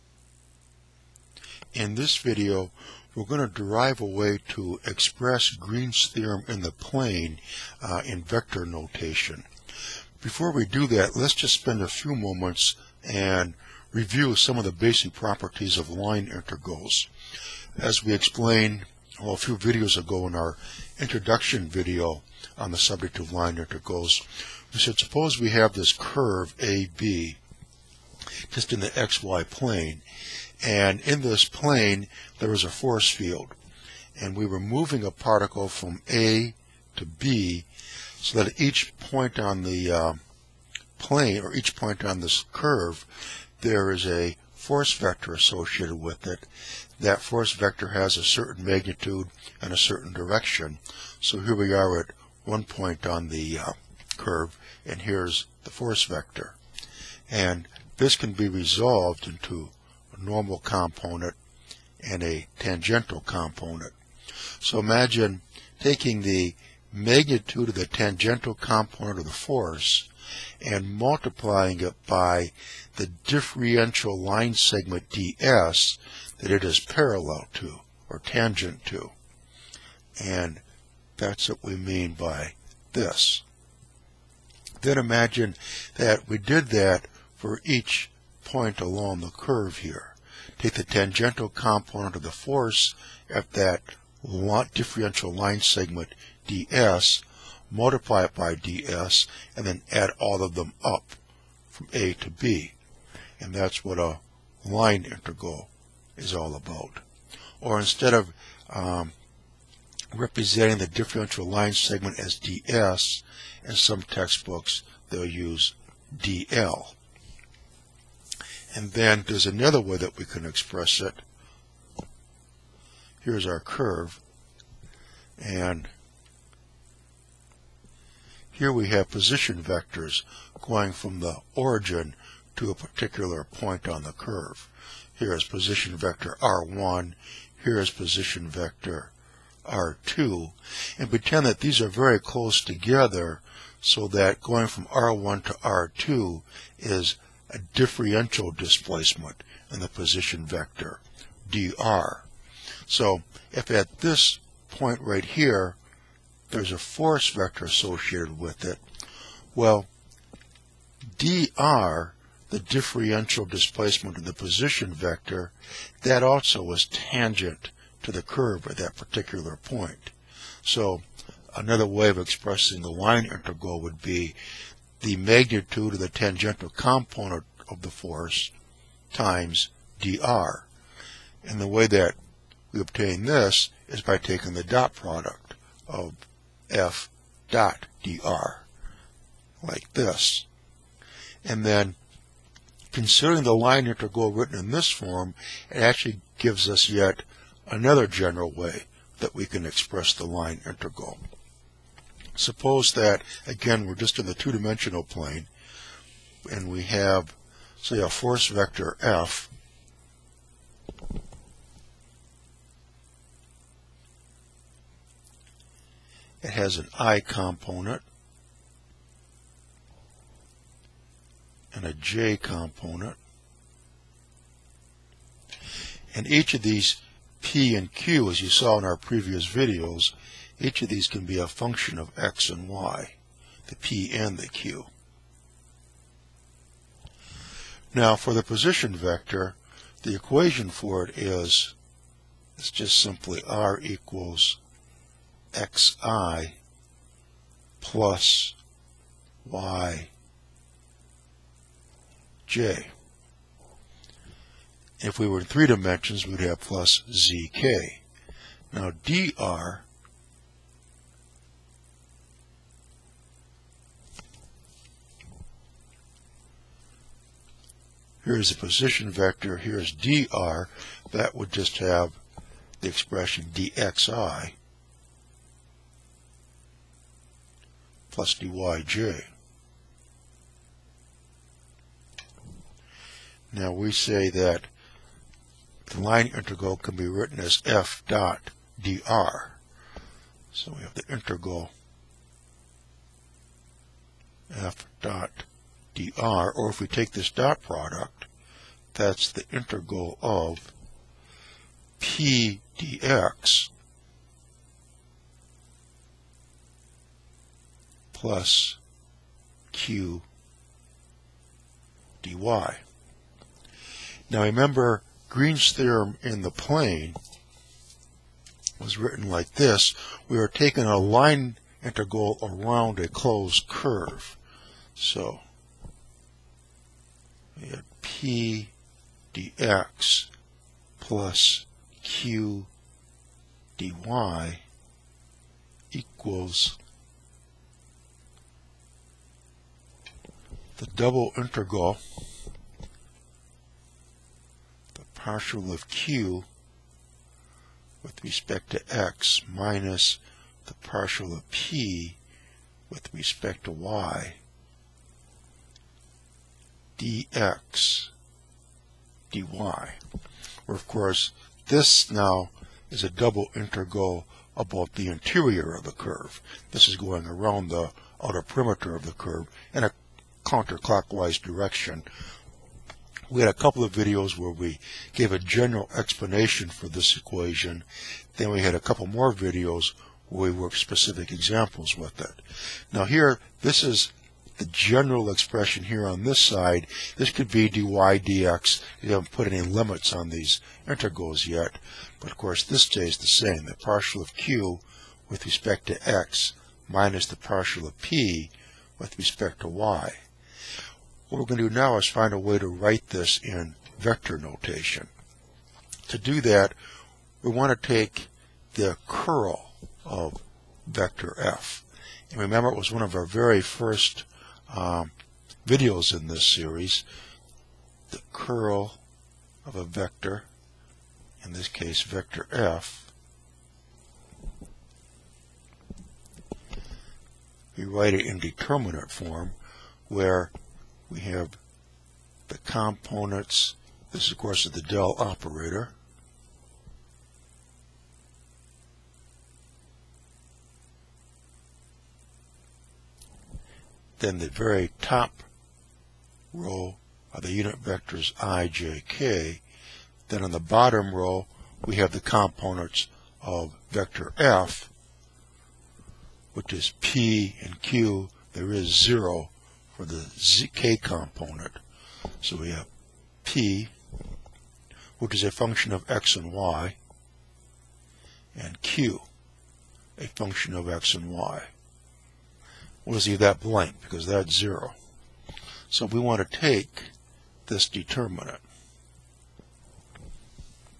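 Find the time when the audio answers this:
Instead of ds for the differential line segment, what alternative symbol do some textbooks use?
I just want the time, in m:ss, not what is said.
1:56.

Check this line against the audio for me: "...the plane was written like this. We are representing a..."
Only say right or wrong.
wrong.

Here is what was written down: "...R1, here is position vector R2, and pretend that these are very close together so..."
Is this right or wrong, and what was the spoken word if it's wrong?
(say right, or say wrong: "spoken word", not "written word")
right.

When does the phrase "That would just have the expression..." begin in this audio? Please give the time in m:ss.
4:31.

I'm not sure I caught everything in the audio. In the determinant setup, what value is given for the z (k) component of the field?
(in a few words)
0.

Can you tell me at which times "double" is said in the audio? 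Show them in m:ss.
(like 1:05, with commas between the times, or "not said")
5:40, 6:03.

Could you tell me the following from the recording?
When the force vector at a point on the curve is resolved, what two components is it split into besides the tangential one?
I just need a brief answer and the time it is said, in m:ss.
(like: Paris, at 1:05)
Normal component, at 1:00.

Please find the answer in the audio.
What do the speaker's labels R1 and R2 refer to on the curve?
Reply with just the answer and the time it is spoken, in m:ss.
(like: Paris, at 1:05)
Position vectors, at 2:09.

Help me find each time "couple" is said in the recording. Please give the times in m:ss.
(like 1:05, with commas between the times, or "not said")
6:13, 6:18.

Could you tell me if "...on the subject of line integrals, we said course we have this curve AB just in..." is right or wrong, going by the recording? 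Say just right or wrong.
wrong.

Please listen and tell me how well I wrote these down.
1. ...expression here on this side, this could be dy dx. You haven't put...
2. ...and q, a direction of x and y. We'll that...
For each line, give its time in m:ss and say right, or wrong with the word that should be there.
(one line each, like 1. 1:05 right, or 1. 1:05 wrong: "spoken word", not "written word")
1. 6:25 right
2. 7:48 wrong: "function", not "direction".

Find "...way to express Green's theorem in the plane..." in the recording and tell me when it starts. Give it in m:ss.
0:04.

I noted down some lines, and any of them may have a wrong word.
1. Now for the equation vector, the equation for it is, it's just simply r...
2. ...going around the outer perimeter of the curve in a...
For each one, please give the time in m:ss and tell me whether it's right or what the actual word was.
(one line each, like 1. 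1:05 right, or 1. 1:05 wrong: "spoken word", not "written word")
1. 3:57 wrong: "position", not "equation"
2. 6:06 right.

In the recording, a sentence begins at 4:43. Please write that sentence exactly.
Now we say that the line integral can be written as f dot dr.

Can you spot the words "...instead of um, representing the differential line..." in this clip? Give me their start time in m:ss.
1:47.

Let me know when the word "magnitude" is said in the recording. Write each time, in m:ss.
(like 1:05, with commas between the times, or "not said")
0:48, 1:06, 2:55.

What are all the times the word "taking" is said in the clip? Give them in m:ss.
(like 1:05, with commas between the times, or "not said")
1:05, 3:04, 5:20.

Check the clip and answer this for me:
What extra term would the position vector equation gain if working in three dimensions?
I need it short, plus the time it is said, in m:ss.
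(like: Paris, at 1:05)
zk, at 4:17.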